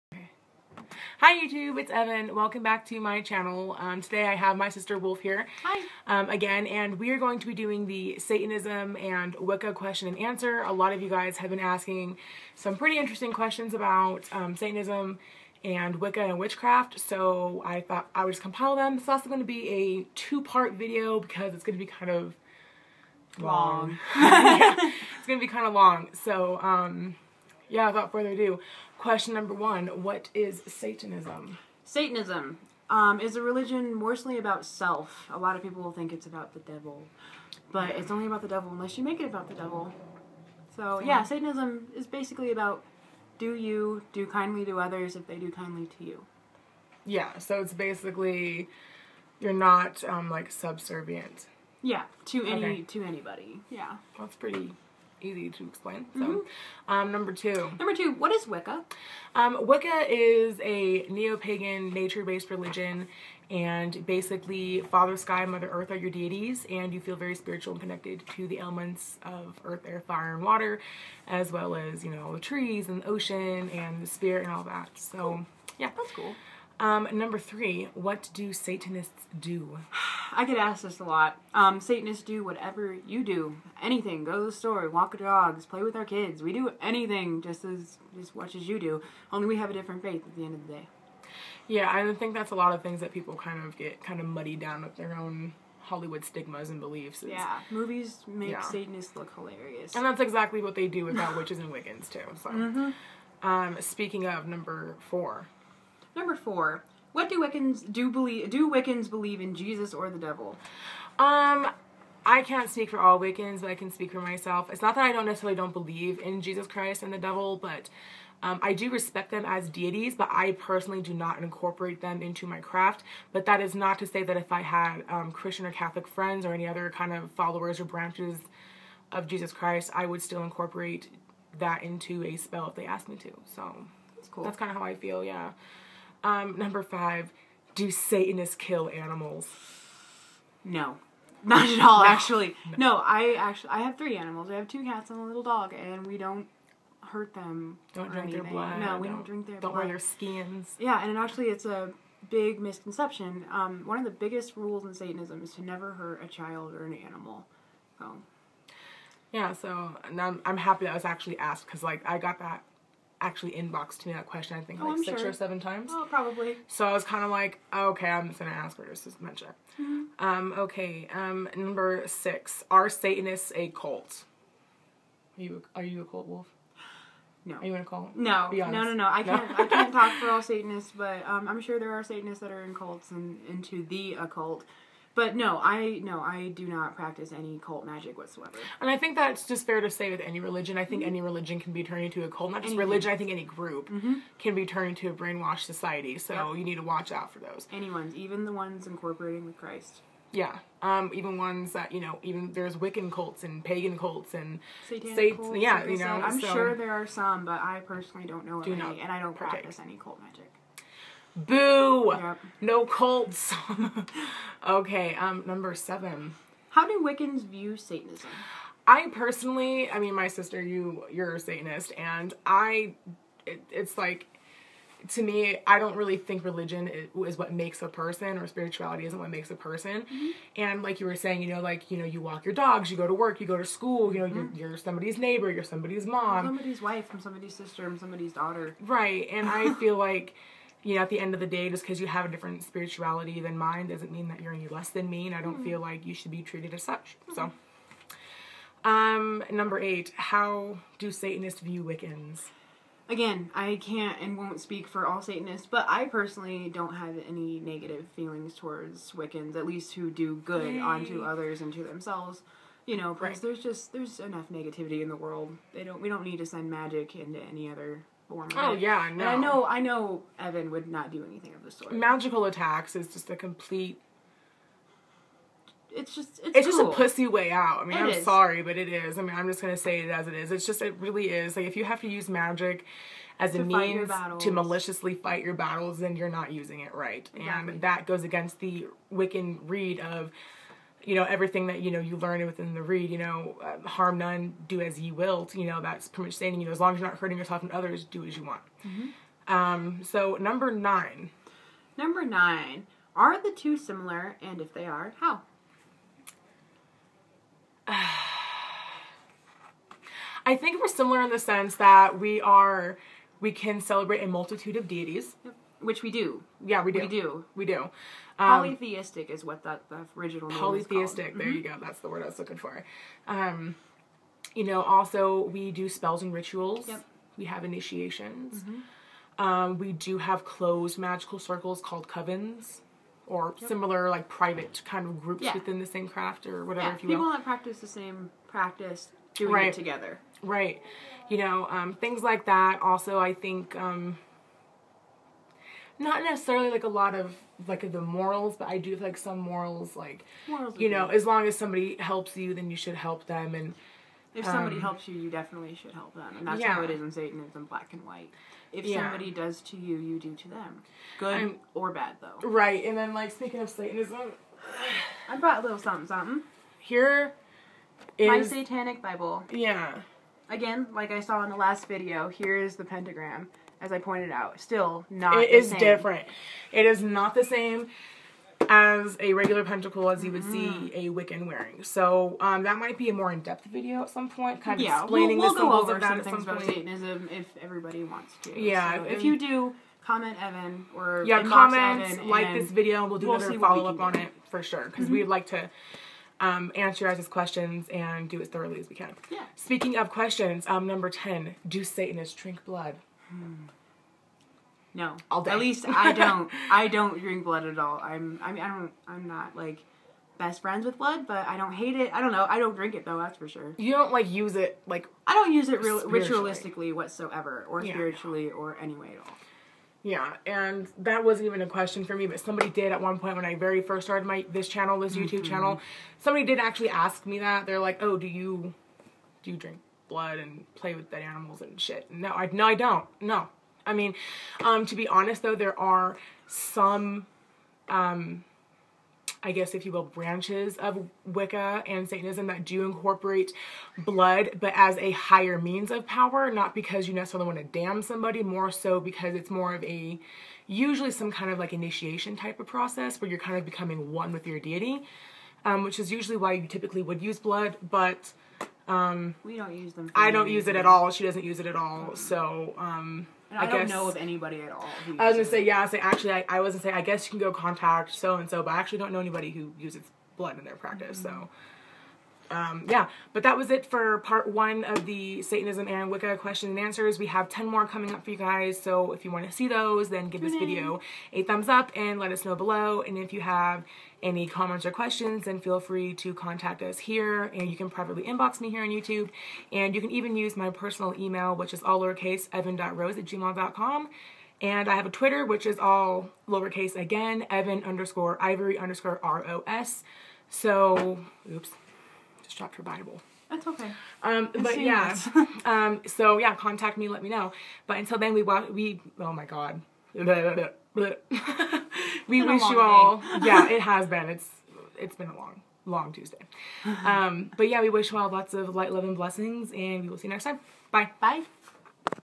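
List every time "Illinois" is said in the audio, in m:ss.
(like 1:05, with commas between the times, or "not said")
not said.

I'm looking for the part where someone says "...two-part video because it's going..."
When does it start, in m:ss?
0:20.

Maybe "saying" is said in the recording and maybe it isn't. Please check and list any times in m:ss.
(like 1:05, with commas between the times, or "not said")
3:51, 4:56.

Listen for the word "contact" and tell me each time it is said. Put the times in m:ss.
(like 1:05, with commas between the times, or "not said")
7:47, 8:06, 8:26.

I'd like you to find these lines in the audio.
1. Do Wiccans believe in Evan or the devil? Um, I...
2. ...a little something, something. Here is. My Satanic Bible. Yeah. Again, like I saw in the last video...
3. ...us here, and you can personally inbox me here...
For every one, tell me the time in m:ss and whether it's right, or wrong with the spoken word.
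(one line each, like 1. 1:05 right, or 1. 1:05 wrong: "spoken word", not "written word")
1. 1:48 wrong: "Jesus", not "Evan"
2. 6:05 right
3. 8:06 wrong: "privately", not "personally".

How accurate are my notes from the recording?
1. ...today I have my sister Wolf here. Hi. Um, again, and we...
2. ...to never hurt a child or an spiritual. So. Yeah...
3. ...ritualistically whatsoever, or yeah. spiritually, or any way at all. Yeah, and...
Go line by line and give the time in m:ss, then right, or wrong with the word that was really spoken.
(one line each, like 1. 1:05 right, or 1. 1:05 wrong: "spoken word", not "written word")
1. 0:04 right
2. 2:35 wrong: "animal", not "spiritual"
3. 6:56 right.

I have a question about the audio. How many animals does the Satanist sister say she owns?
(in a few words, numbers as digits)
3.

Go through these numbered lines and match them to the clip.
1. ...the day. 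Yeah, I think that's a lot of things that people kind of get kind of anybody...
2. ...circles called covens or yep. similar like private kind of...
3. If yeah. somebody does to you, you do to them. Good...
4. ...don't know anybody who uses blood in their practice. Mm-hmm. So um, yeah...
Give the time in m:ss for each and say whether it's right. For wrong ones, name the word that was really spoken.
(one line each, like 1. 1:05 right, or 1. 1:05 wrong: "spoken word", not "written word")
1. 1:30 wrong: "muddy", not "anybody"
2. 5:31 right
3. 5:58 right
4. 7:48 right.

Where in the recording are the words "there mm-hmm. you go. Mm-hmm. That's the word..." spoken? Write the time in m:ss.
5:21.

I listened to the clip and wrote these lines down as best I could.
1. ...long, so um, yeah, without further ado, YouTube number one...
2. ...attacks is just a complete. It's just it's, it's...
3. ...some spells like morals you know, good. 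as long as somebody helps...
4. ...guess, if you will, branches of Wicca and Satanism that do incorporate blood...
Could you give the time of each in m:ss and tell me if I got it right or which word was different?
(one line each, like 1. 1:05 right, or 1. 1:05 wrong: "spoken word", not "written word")
1. 0:25 wrong: "Question", not "YouTube"
2. 4:32 right
3. 5:49 wrong: "morals", not "spells"
4. 7:19 right.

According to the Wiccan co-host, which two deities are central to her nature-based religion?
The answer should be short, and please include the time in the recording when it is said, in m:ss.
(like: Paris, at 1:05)
Father Sky, Mother Earth, at 1:04.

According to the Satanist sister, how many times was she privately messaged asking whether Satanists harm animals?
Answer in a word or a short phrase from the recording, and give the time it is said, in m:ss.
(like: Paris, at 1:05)
6 or 7, at 2:45.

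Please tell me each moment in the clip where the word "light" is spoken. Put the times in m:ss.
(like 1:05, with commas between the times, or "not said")
8:38.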